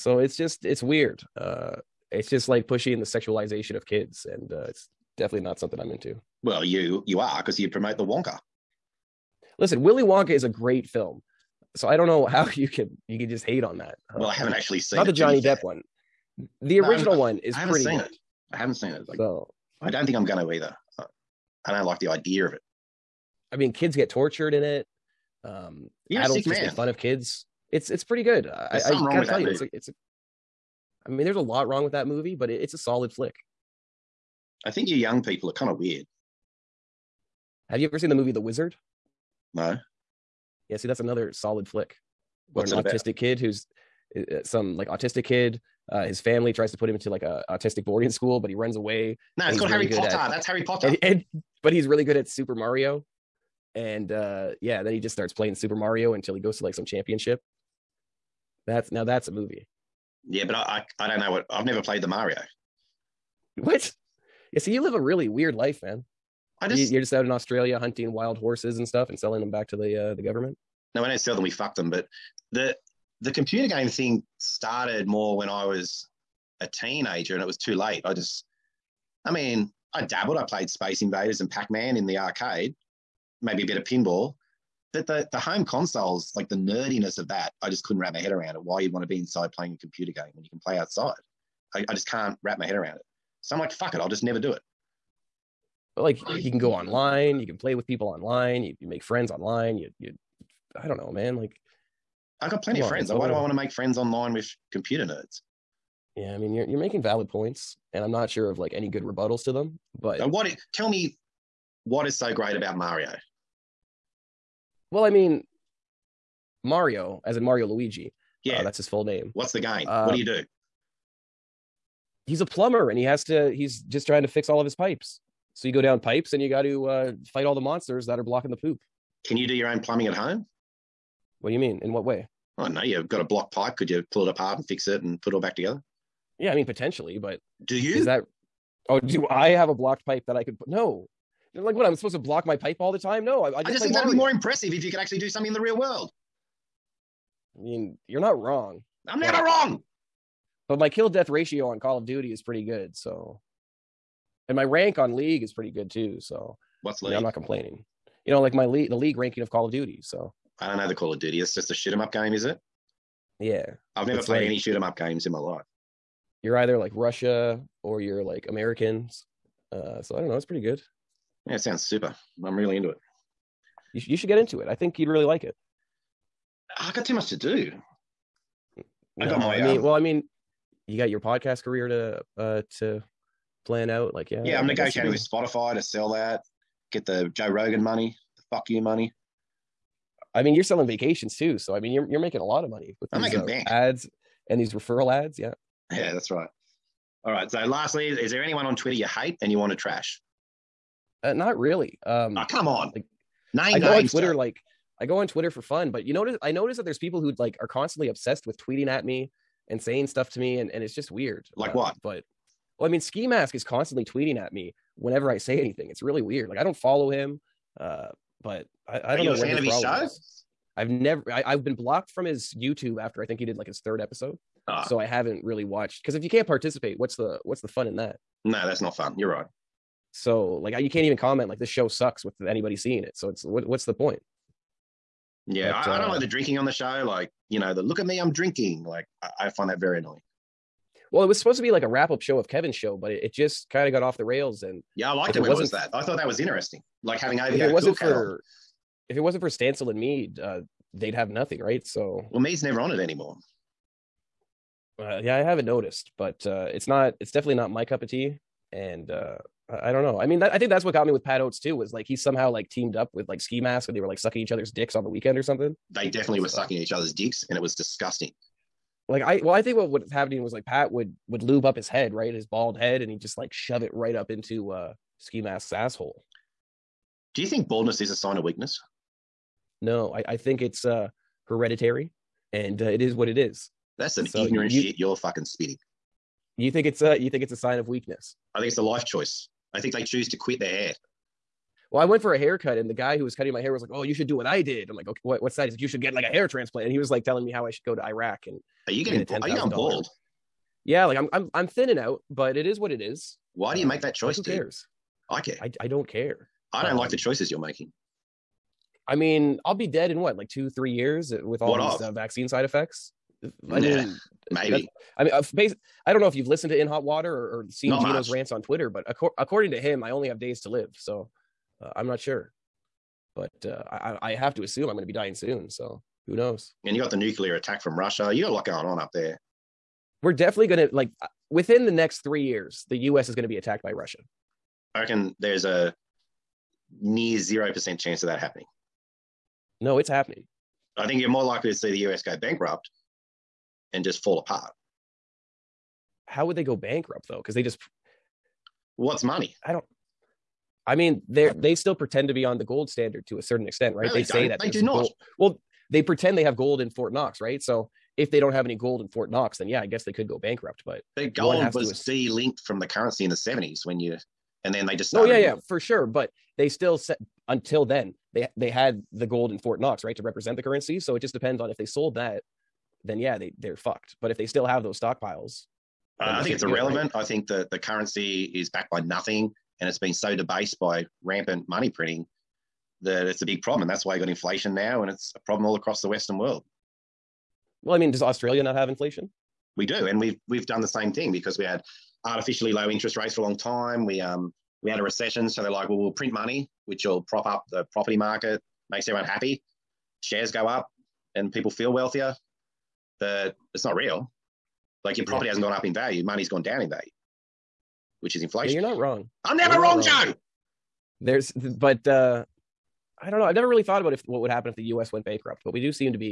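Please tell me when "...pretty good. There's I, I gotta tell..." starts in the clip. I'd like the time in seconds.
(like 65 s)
28 s.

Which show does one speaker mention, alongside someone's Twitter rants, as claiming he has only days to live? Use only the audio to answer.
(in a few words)
In Hot Water.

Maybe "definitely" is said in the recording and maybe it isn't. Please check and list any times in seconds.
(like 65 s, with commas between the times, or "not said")
5 s, 257 s, 266 s, 330 s.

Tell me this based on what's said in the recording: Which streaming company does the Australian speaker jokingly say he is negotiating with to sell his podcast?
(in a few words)
Spotify.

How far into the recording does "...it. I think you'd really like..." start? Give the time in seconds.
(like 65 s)
174 s.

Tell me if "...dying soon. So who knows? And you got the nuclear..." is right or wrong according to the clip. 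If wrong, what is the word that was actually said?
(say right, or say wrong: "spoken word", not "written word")
right.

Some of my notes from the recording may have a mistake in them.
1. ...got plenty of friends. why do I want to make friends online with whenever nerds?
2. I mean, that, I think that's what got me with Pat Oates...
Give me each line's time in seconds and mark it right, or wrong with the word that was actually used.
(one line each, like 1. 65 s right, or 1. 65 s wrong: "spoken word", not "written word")
1. 102 s wrong: "computer", not "whenever"
2. 260 s right.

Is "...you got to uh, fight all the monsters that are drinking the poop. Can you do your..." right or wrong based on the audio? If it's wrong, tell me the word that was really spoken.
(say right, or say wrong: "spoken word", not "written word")
wrong: "blocking", not "drinking".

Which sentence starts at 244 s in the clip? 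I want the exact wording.
And yeah, I liked it, it when it was that.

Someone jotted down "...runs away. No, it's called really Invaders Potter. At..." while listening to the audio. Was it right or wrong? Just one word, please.
wrong.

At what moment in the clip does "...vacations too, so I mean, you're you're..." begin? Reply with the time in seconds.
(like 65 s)
190 s.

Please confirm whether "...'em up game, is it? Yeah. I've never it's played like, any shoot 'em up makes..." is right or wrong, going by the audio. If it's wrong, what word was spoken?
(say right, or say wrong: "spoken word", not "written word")
wrong: "games", not "makes".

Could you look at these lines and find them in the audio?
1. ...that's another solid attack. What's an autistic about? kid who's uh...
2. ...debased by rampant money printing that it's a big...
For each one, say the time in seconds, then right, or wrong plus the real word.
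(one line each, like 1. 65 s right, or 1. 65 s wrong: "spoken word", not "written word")
1. 40 s wrong: "flick", not "attack"
2. 380 s right.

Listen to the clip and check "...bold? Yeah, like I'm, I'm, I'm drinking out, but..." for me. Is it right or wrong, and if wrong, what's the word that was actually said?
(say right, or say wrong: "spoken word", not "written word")
wrong: "thinning", not "drinking".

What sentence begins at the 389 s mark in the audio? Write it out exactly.
We do, and we've we've done the same thing because we had artificially low interest rates for a long time.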